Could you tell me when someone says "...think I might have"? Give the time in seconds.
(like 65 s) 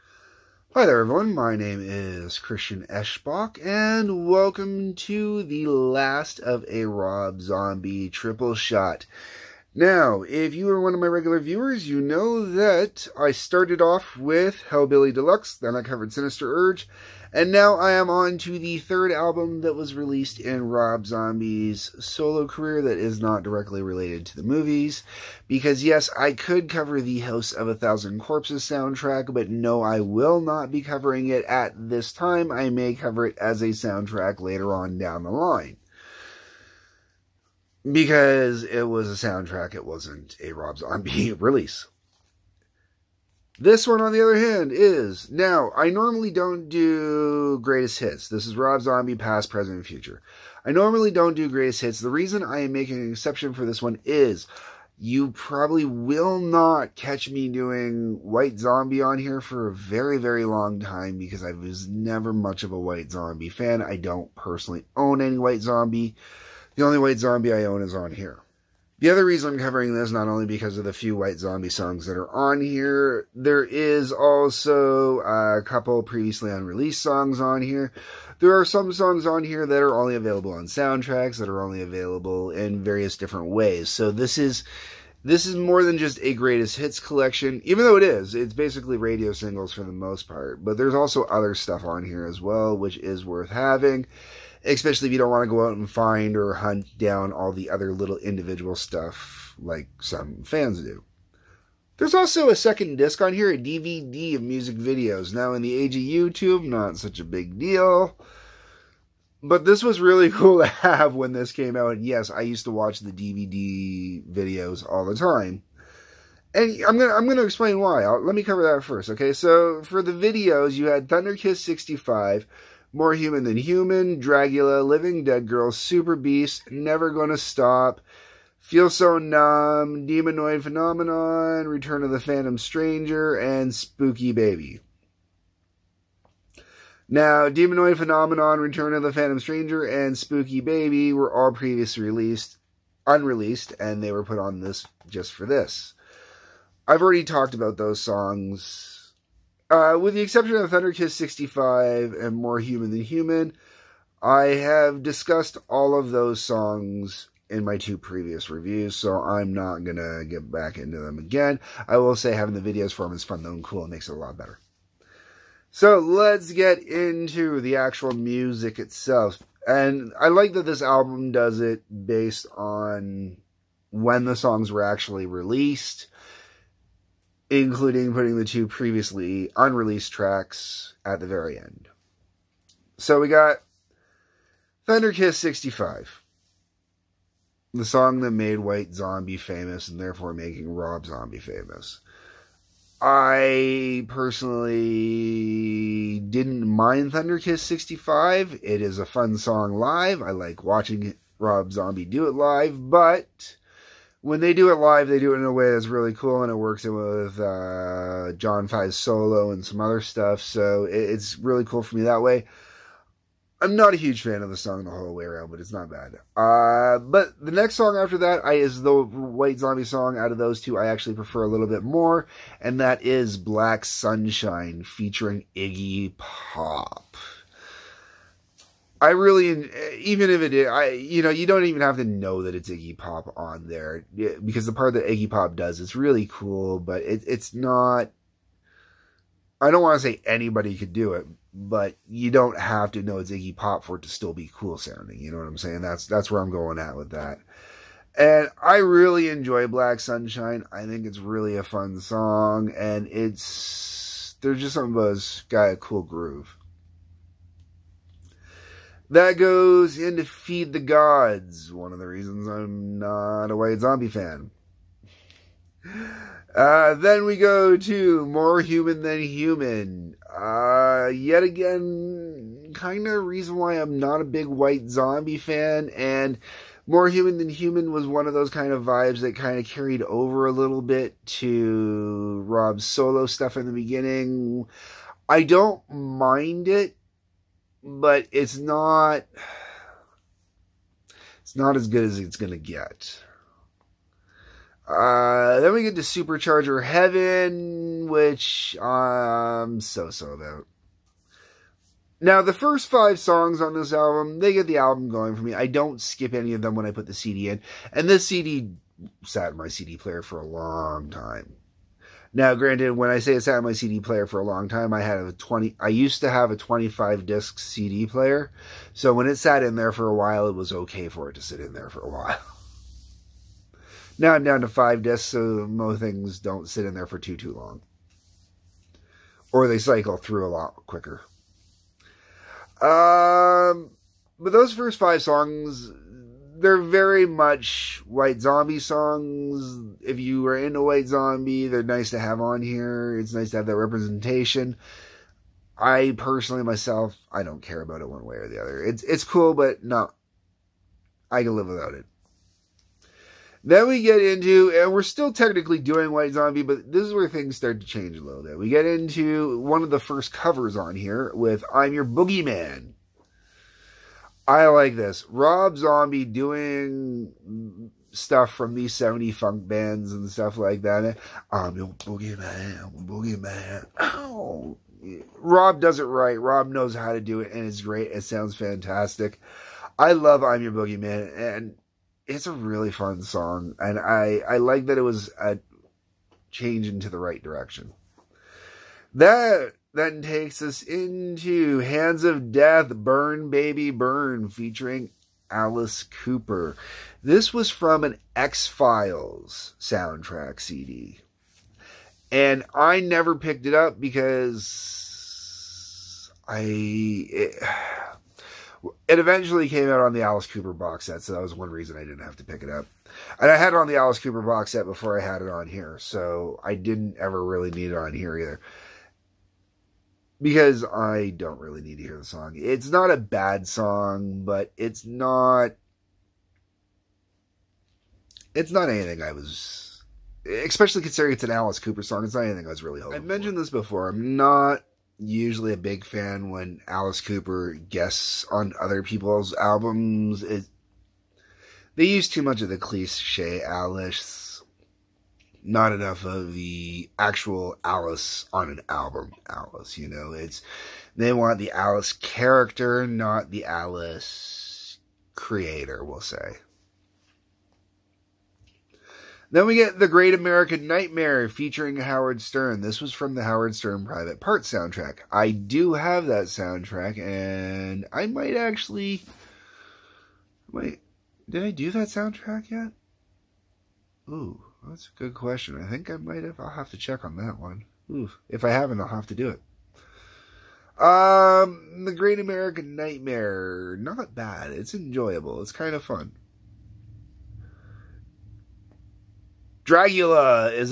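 475 s.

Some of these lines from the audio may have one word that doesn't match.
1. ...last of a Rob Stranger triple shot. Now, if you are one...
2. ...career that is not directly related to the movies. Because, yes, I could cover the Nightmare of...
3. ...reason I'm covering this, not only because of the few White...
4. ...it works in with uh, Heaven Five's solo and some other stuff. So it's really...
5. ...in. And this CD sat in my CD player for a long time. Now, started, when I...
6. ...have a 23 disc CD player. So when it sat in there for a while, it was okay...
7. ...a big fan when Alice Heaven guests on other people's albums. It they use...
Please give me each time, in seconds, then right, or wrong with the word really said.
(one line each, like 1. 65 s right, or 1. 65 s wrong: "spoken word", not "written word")
1. 5 s wrong: "Zombie", not "Stranger"
2. 22 s wrong: "House", not "Nightmare"
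3. 69 s right
4. 206 s wrong: "John", not "Heaven"
5. 307 s wrong: "granted", not "started"
6. 316 s wrong: "25", not "23"
7. 435 s wrong: "Cooper", not "Heaven".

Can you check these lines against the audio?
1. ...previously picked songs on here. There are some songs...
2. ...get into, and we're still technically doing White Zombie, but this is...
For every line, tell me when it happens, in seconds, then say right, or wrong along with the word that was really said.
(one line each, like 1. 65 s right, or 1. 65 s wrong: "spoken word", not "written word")
1. 76 s wrong: "unreleased", not "picked"
2. 354 s right.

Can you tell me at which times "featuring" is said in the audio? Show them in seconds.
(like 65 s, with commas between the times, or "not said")
224 s, 394 s, 461 s.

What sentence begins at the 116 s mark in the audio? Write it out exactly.
And I'm gonna I'm gonna explain why.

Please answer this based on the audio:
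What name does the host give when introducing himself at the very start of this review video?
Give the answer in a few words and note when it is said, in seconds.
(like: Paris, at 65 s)
Christian Eschbach, at 2 s.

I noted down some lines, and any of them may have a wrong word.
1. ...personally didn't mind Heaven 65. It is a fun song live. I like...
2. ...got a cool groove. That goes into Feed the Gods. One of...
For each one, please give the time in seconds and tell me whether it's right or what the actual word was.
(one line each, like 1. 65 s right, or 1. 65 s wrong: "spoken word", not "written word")
1. 194 s wrong: "Thunderkiss", not "Heaven"
2. 255 s right.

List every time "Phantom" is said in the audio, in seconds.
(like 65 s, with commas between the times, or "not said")
132 s, 139 s.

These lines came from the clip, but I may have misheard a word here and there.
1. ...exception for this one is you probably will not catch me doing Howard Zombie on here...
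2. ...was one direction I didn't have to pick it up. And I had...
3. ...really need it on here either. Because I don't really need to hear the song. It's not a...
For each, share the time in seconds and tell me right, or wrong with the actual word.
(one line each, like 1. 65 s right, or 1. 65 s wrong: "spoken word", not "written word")
1. 53 s wrong: "White", not "Howard"
2. 411 s wrong: "reason", not "direction"
3. 417 s right.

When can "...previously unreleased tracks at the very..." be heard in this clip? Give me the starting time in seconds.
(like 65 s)
178 s.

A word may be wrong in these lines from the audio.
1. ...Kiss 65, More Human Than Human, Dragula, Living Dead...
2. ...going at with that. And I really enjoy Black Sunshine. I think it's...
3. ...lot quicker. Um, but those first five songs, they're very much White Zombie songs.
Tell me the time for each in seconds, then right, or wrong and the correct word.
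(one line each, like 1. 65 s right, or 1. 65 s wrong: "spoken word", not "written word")
1. 121 s right
2. 246 s right
3. 330 s right.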